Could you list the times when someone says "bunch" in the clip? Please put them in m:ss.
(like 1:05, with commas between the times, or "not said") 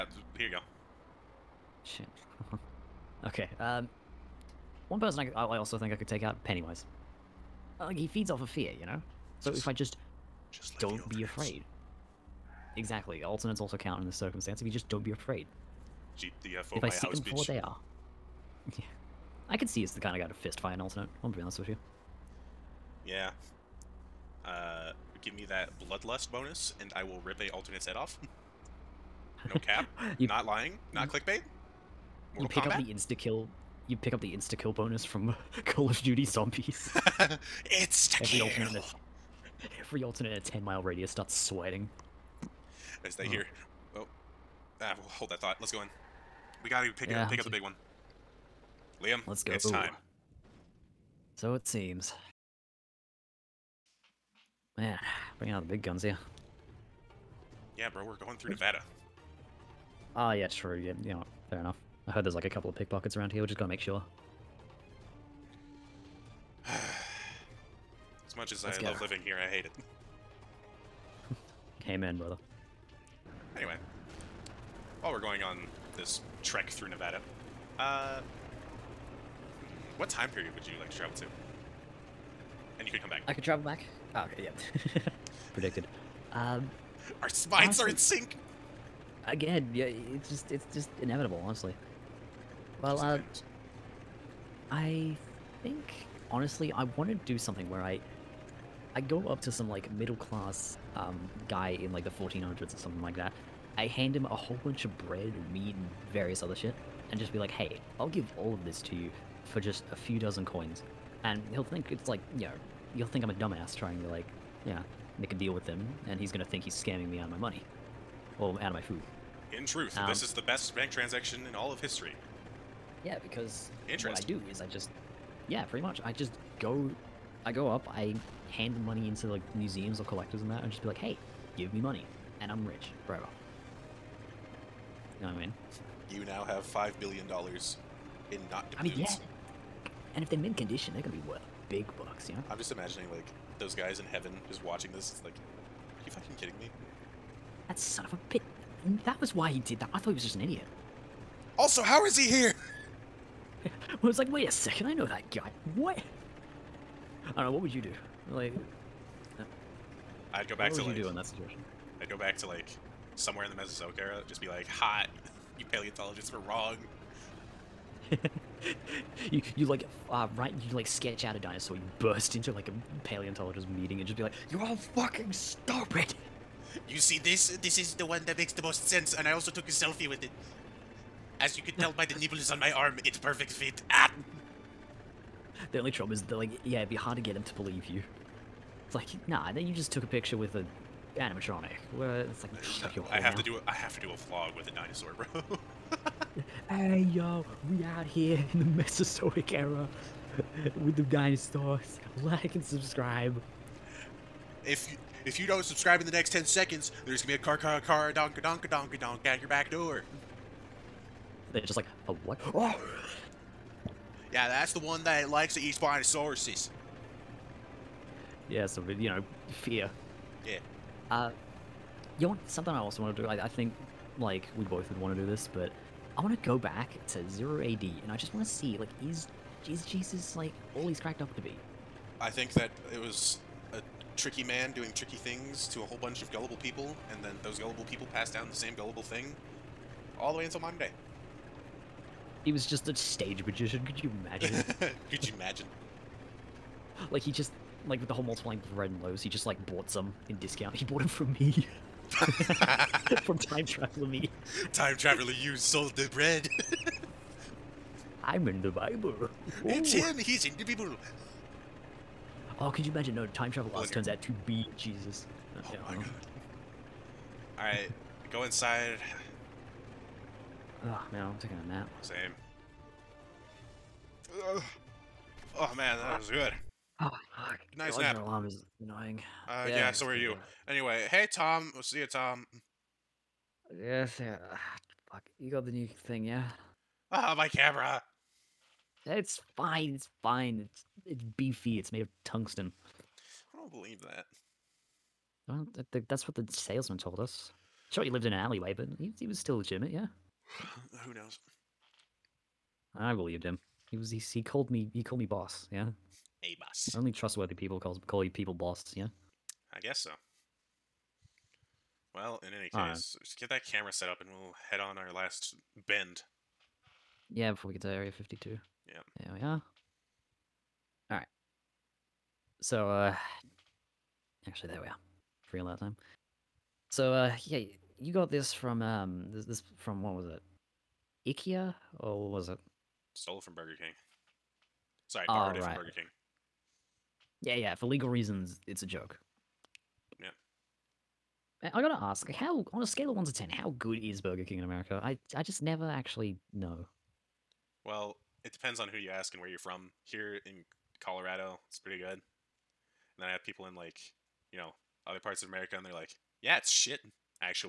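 1:44, 3:56.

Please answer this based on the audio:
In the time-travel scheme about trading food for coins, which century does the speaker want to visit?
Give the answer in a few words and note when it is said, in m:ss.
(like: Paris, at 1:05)
1400s, at 1:42.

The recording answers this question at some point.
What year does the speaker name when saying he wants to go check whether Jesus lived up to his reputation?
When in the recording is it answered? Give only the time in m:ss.
3:47.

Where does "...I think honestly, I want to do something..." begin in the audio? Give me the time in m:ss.
1:34.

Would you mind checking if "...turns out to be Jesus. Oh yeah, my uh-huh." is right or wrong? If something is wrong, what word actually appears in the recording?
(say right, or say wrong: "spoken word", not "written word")
right.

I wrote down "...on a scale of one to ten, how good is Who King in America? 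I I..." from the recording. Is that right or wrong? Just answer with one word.
wrong.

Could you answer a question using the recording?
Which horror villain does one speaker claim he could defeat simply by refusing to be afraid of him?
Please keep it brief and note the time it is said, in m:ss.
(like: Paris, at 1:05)
Pennywise, at 0:06.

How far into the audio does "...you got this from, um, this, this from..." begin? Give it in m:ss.
5:27.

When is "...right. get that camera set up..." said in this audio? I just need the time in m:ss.
5:13.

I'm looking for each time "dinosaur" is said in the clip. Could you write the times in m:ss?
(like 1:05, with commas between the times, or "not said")
2:51, 3:14, 3:21.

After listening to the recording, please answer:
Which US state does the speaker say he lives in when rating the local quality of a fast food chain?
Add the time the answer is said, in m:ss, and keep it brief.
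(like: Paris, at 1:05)
Colorado, at 5:50.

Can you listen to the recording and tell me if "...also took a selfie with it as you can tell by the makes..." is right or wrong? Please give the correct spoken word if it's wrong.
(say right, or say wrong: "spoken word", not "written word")
wrong: "nibbles", not "makes".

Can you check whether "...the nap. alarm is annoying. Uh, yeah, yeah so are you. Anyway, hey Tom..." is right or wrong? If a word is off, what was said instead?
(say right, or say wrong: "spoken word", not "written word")
right.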